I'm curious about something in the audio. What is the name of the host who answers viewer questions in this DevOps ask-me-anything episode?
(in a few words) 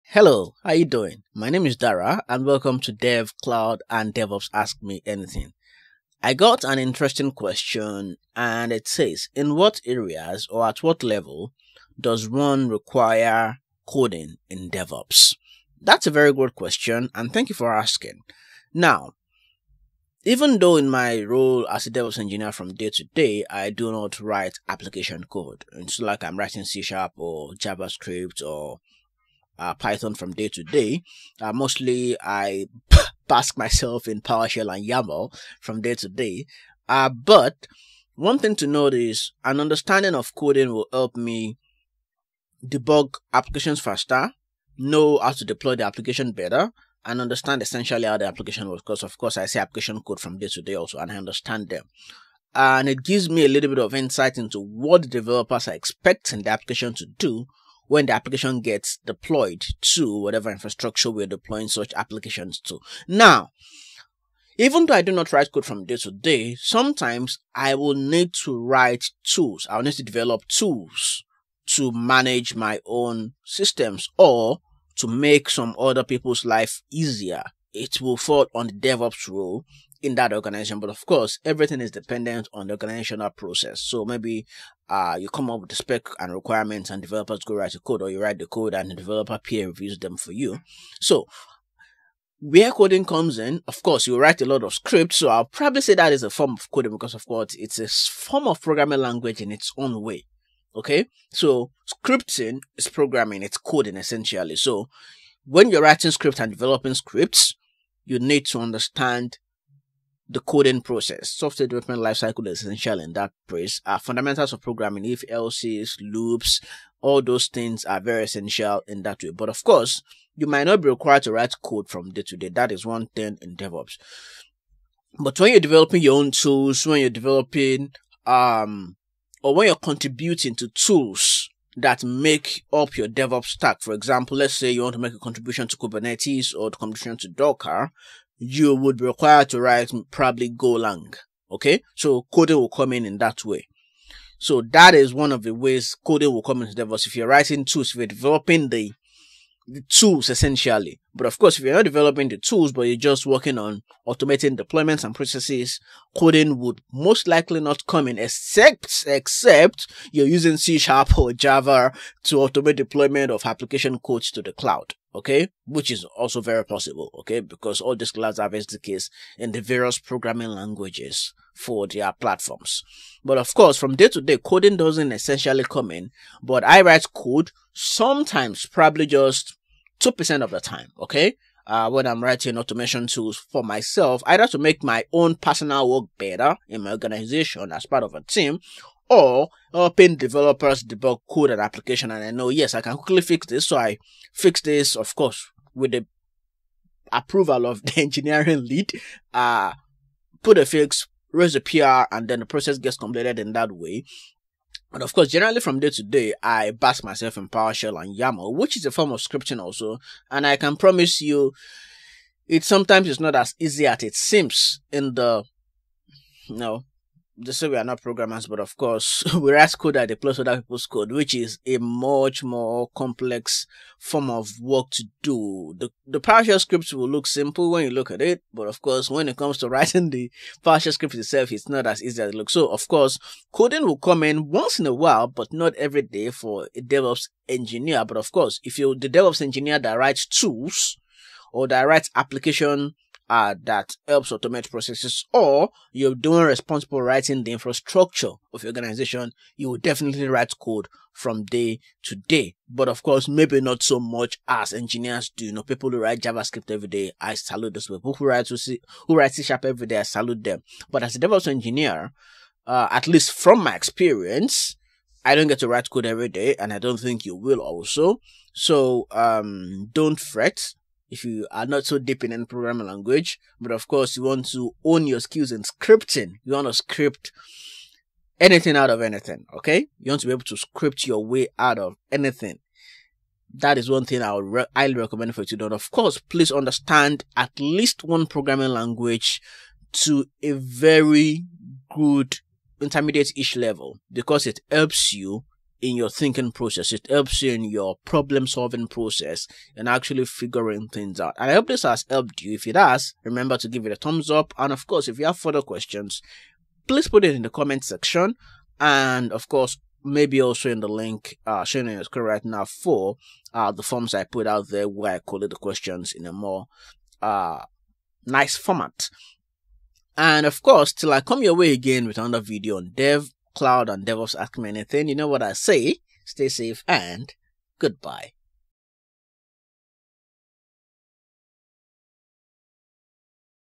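Dara.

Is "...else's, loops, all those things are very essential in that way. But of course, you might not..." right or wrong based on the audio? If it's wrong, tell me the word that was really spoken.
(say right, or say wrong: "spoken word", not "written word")
right.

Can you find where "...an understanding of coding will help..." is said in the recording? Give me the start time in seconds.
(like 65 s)
39 s.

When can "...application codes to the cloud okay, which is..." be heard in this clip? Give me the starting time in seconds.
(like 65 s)
163 s.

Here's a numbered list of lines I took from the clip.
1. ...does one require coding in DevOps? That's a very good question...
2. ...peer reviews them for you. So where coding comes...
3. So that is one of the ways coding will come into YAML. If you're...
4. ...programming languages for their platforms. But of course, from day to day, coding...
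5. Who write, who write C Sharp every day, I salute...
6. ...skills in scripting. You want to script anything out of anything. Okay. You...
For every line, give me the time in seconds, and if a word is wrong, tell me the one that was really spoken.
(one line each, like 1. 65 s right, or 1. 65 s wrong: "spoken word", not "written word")
1. 11 s right
2. 89 s right
3. 144 s wrong: "DevOps", not "YAML"
4. 169 s right
5. 258 s right
6. 275 s right.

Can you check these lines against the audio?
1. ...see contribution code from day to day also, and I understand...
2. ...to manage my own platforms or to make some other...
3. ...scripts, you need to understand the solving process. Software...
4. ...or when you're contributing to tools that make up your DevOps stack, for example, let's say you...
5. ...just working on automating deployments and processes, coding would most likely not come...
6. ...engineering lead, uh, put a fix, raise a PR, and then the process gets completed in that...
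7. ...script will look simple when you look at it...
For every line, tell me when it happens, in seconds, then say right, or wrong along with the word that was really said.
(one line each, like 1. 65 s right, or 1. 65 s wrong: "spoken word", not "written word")
1. 49 s wrong: "application", not "contribution"
2. 71 s wrong: "systems", not "platforms"
3. 106 s wrong: "coding", not "solving"
4. 129 s right
5. 152 s right
6. 198 s right
7. 226 s right.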